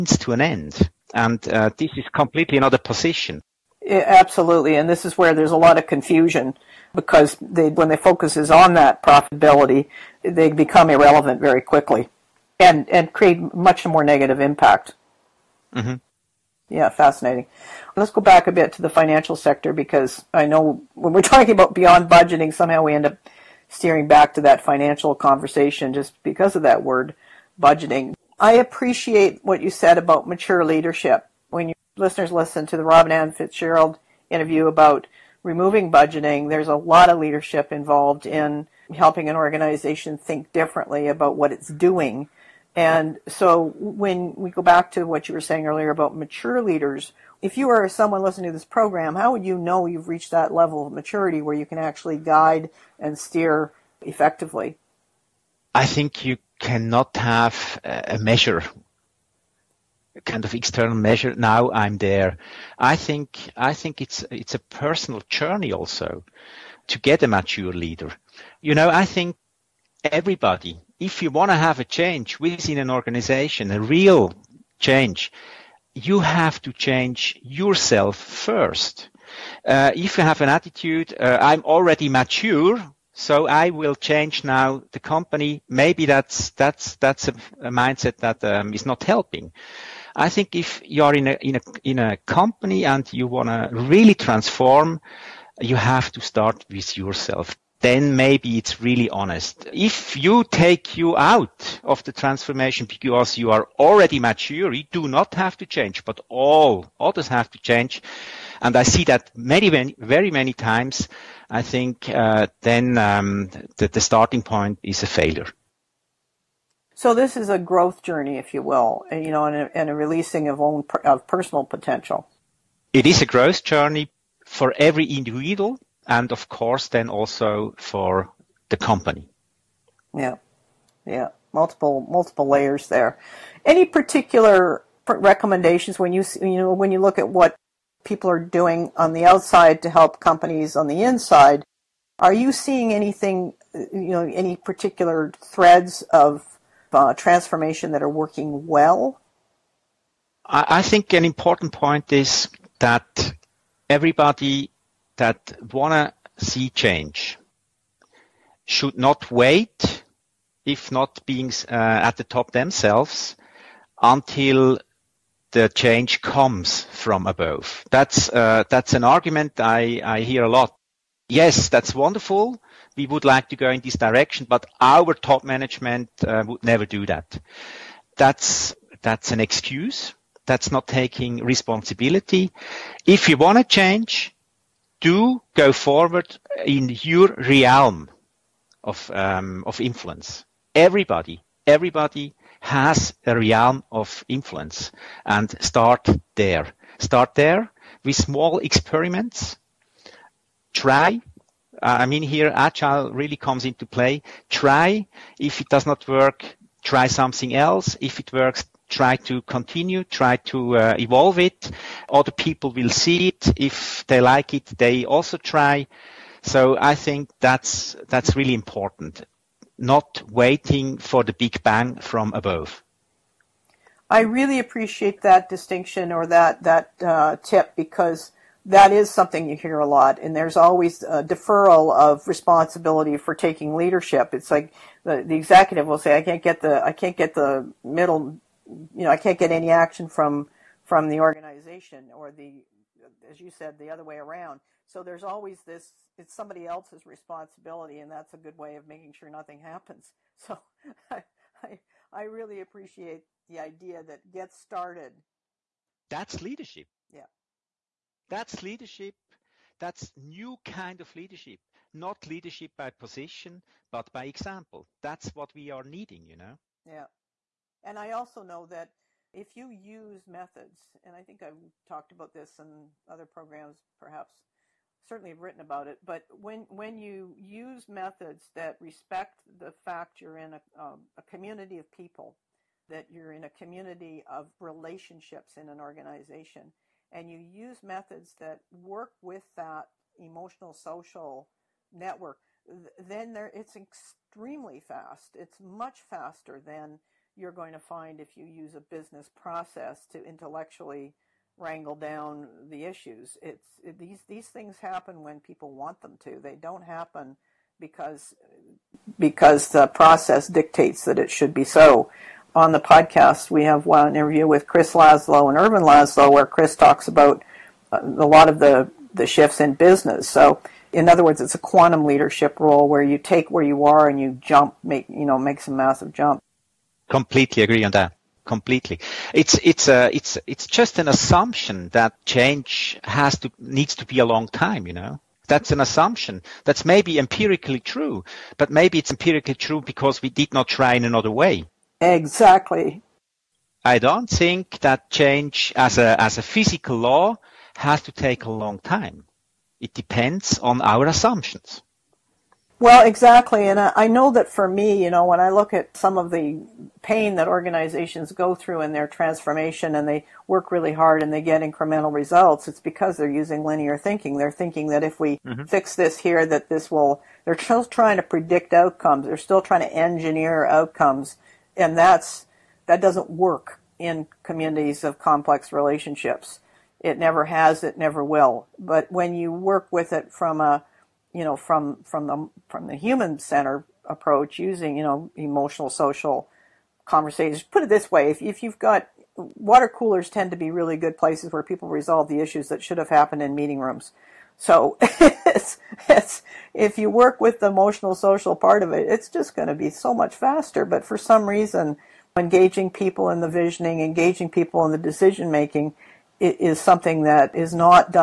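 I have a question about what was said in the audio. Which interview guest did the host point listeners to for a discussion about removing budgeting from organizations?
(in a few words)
Robin Ann Fitzgerald.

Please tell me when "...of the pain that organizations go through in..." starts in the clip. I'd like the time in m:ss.
5:56.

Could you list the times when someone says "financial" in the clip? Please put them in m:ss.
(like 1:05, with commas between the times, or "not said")
0:18, 0:24.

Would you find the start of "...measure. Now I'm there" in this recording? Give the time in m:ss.
1:00.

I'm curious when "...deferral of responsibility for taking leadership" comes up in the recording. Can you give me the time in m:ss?
3:51.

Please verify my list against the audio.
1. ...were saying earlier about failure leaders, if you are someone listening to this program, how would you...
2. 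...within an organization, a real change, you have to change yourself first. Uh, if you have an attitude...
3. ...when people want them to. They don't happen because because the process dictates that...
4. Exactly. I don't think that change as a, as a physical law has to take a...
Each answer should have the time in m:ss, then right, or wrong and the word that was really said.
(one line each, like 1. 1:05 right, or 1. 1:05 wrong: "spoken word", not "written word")
1. 0:45 wrong: "mature", not "failure"
2. 1:12 right
3. 5:05 right
4. 5:42 right.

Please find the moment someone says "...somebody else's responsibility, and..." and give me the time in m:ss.
4:06.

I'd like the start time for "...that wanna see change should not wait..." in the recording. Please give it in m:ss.
2:35.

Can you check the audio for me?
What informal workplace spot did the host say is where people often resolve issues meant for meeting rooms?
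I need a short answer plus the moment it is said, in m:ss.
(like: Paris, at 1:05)
Water coolers, at 6:29.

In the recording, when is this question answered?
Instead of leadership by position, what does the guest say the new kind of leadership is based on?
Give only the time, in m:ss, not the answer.
4:24.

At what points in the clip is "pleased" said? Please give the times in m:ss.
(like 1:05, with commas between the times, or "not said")
not said.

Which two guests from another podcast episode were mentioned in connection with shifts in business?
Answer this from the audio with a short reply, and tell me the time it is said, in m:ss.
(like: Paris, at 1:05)
Chris Laszlo and Ervin Laszlo, at 5:14.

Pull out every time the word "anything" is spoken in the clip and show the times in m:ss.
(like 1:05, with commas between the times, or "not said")
2:22.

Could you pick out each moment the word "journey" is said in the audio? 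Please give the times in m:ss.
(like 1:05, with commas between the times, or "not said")
1:05, 1:58, 2:03.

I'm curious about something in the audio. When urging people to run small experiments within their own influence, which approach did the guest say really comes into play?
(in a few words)
Agile.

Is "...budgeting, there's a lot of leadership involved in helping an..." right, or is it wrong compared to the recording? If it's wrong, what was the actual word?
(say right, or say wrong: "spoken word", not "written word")
right.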